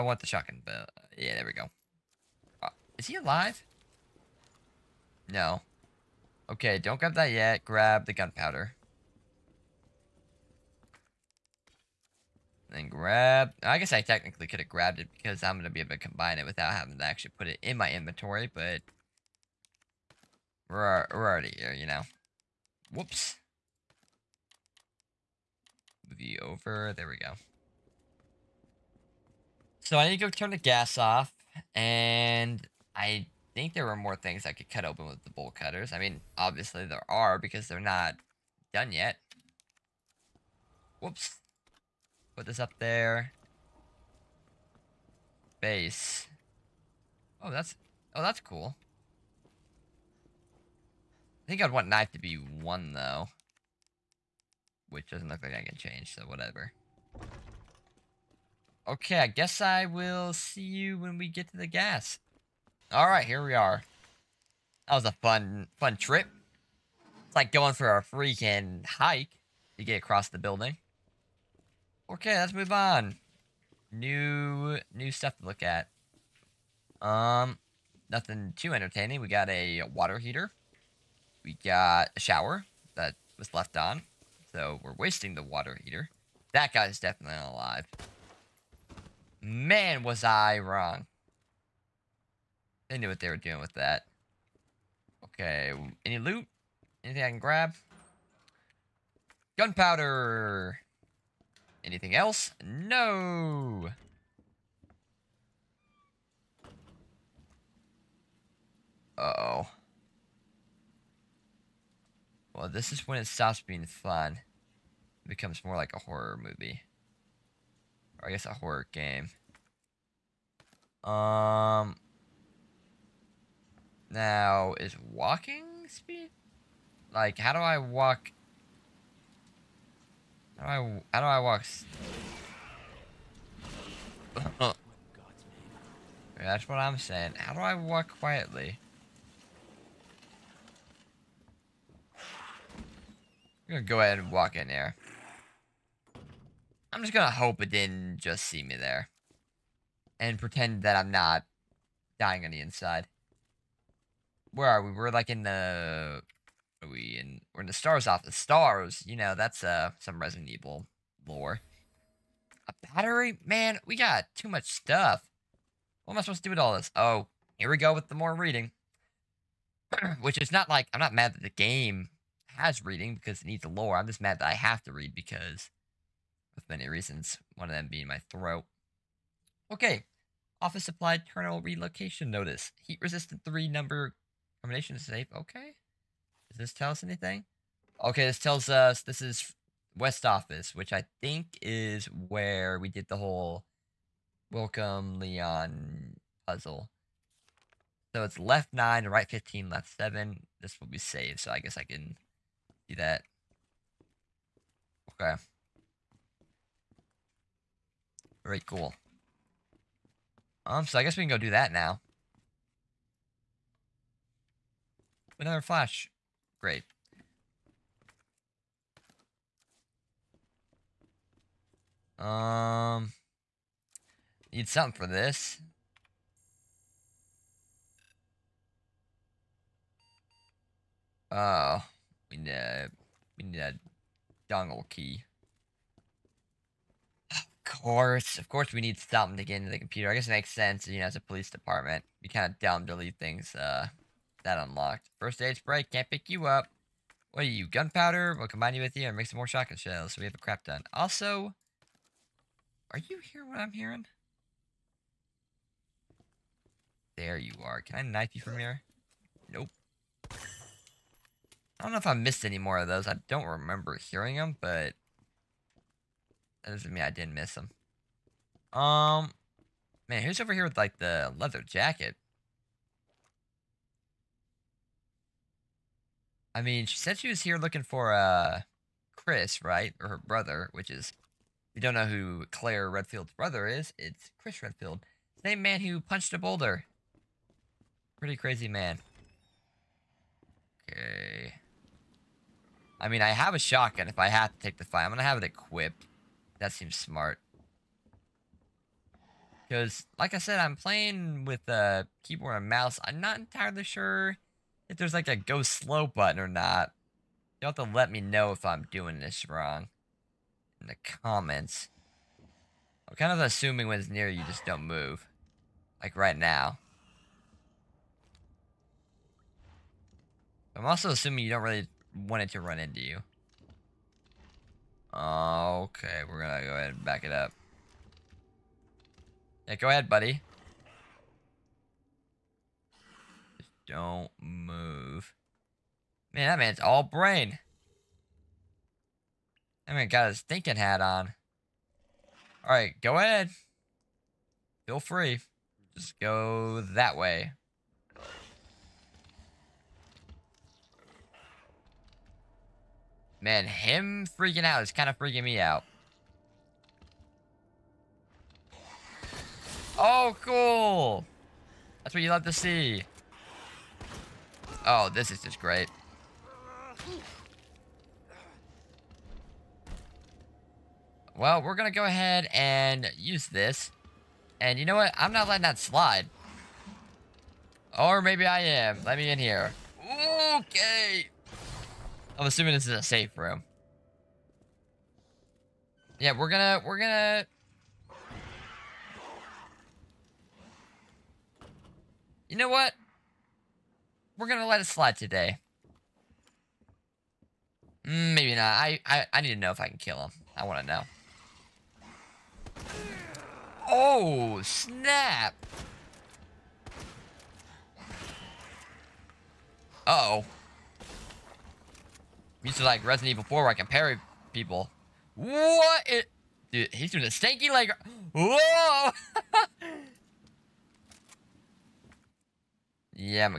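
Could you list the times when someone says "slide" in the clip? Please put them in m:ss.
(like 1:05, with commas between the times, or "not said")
6:15, 6:34.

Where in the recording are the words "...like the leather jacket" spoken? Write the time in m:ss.
4:30.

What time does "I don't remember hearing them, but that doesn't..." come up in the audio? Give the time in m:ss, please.
4:23.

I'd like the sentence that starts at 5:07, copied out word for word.
You'll have to let me know if I'm doing this wrong in the comments.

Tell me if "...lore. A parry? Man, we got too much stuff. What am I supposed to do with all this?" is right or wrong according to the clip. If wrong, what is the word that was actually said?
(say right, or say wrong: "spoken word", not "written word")
wrong: "battery", not "parry".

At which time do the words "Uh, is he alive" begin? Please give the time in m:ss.
0:02.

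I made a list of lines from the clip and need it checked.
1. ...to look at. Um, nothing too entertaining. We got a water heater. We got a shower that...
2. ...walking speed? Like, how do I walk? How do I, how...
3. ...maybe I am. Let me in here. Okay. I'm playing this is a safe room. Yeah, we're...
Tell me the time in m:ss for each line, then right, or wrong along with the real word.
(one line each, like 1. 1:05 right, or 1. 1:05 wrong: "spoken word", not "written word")
1. 1:15 right
2. 2:05 right
3. 6:18 wrong: "assuming", not "playing".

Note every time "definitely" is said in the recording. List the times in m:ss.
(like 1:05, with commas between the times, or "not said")
1:26.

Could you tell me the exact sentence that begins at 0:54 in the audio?
Which doesn't look like I can change, so whatever.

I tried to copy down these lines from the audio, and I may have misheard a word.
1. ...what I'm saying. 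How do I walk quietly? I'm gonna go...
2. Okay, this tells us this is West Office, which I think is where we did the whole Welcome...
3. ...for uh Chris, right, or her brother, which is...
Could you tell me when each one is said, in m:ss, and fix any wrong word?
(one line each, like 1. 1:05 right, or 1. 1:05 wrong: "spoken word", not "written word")
1. 2:16 right
2. 3:08 right
3. 4:37 right.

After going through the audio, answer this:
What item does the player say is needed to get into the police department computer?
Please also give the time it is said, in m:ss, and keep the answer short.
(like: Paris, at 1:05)
dongle key, at 3:54.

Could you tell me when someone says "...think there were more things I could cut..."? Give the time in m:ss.
0:33.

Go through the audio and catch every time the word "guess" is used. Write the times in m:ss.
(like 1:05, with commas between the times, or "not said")
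0:13, 0:59, 1:58, 3:21, 3:31, 4:00.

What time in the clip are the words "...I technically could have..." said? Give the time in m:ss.
0:13.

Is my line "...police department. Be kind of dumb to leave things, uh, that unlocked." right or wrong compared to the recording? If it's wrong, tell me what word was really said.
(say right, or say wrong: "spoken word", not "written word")
right.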